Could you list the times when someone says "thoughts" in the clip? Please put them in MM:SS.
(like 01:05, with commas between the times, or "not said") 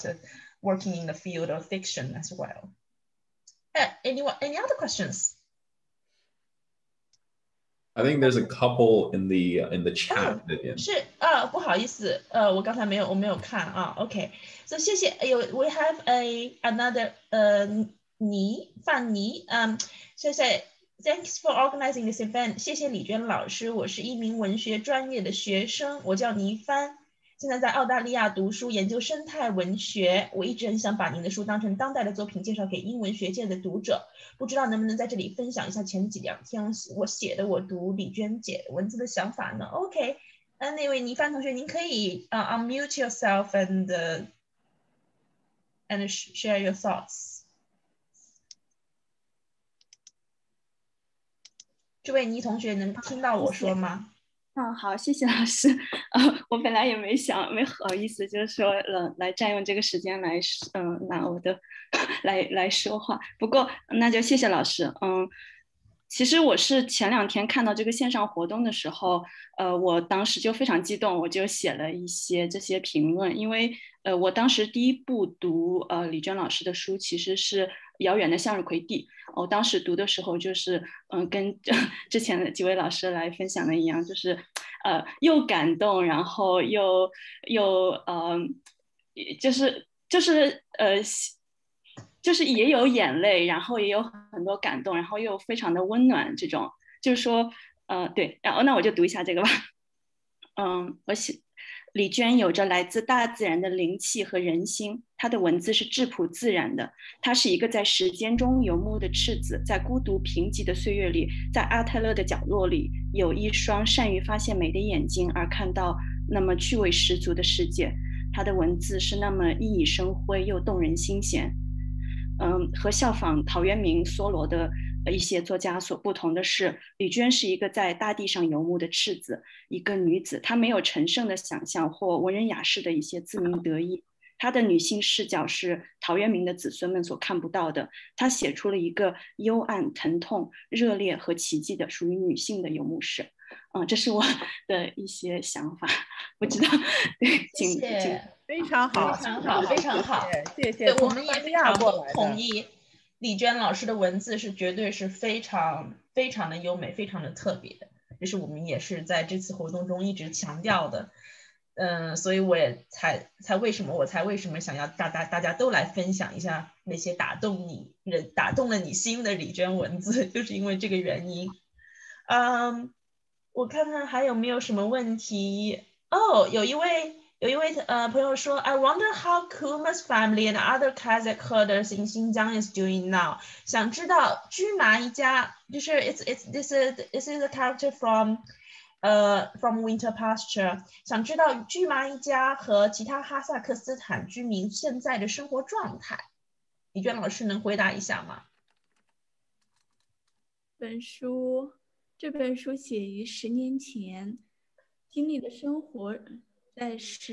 00:46.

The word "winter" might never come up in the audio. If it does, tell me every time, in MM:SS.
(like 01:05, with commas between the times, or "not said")
03:09.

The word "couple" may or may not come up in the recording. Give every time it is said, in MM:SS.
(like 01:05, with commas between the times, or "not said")
00:08.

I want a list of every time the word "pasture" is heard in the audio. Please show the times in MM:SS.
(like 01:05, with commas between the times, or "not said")
03:10.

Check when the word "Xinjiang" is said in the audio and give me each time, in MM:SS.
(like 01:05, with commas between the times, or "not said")
03:02.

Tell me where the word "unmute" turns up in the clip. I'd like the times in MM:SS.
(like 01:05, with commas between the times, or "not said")
00:42.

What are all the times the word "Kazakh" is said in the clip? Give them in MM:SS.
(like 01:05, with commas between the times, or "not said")
03:00.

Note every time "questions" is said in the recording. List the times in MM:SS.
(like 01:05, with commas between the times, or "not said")
00:04.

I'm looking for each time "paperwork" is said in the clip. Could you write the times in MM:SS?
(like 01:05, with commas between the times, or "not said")
not said.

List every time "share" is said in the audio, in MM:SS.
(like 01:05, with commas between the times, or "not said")
00:46.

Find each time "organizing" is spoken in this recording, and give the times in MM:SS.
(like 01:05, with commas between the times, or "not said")
00:21.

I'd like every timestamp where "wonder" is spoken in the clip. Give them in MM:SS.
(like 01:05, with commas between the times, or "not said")
02:58.